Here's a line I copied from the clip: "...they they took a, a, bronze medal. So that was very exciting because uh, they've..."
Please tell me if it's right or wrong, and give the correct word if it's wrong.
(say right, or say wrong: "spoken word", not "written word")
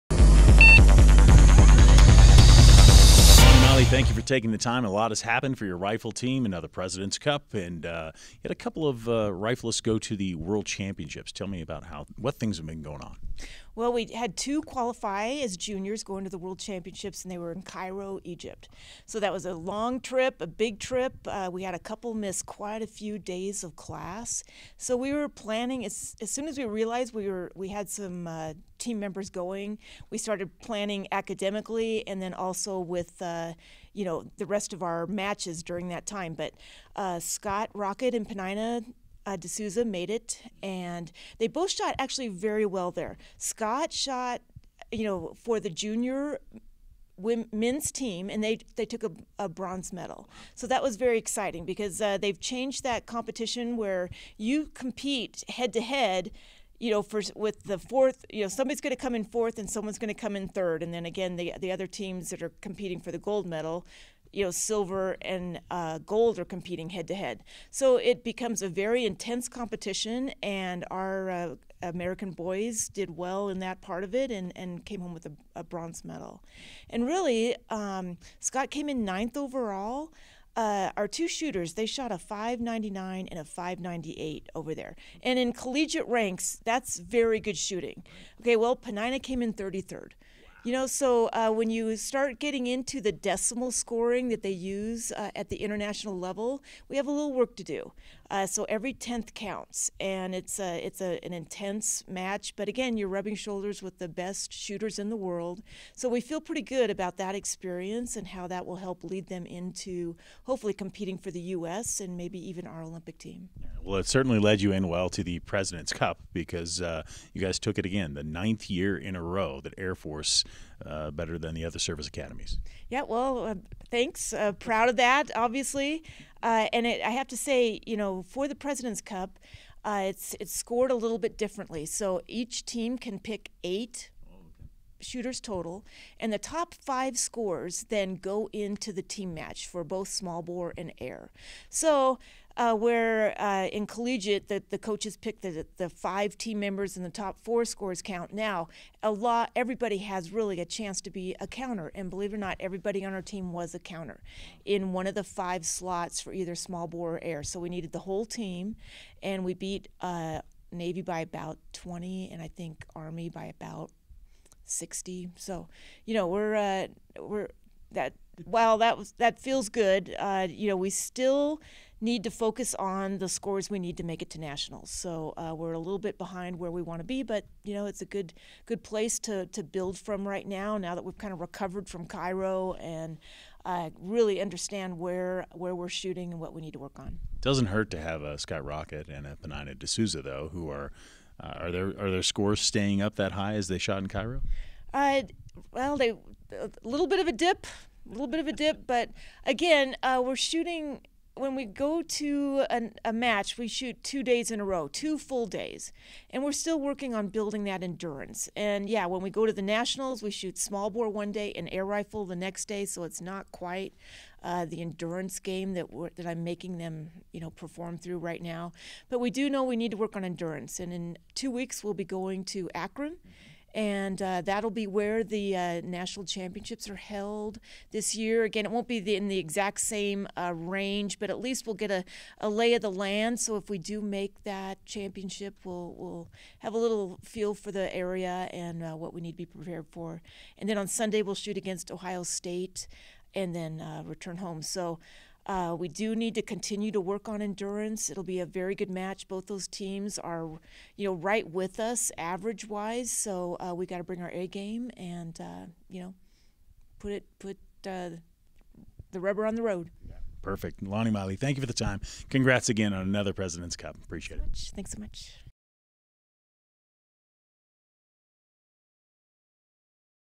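right.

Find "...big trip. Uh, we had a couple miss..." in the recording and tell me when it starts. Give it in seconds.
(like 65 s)
20 s.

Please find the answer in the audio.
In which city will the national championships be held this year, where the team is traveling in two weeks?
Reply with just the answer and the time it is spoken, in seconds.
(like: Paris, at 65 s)
Akron, at 222 s.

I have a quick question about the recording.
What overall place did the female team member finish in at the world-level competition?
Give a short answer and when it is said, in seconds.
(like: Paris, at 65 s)
33rd, at 89 s.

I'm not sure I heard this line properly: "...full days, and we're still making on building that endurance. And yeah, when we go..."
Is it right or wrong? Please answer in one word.
wrong.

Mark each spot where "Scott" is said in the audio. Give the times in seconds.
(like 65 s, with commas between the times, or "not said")
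37 s, 43 s, 78 s, 188 s.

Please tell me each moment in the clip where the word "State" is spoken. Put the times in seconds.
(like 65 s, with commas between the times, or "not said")
242 s.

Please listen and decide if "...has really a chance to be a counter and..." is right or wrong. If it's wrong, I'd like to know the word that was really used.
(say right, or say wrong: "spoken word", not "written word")
right.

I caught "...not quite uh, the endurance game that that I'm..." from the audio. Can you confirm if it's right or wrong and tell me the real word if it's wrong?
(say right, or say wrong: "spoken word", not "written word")
right.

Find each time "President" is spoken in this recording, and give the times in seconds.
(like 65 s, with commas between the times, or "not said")
6 s, 115 s, 128 s, 263 s.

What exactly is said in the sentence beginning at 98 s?
Uh, so every tenth counts, and it's a, it's a, an intense match.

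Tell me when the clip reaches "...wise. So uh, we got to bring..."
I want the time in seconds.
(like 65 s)
252 s.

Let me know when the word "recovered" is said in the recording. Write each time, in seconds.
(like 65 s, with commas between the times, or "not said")
181 s.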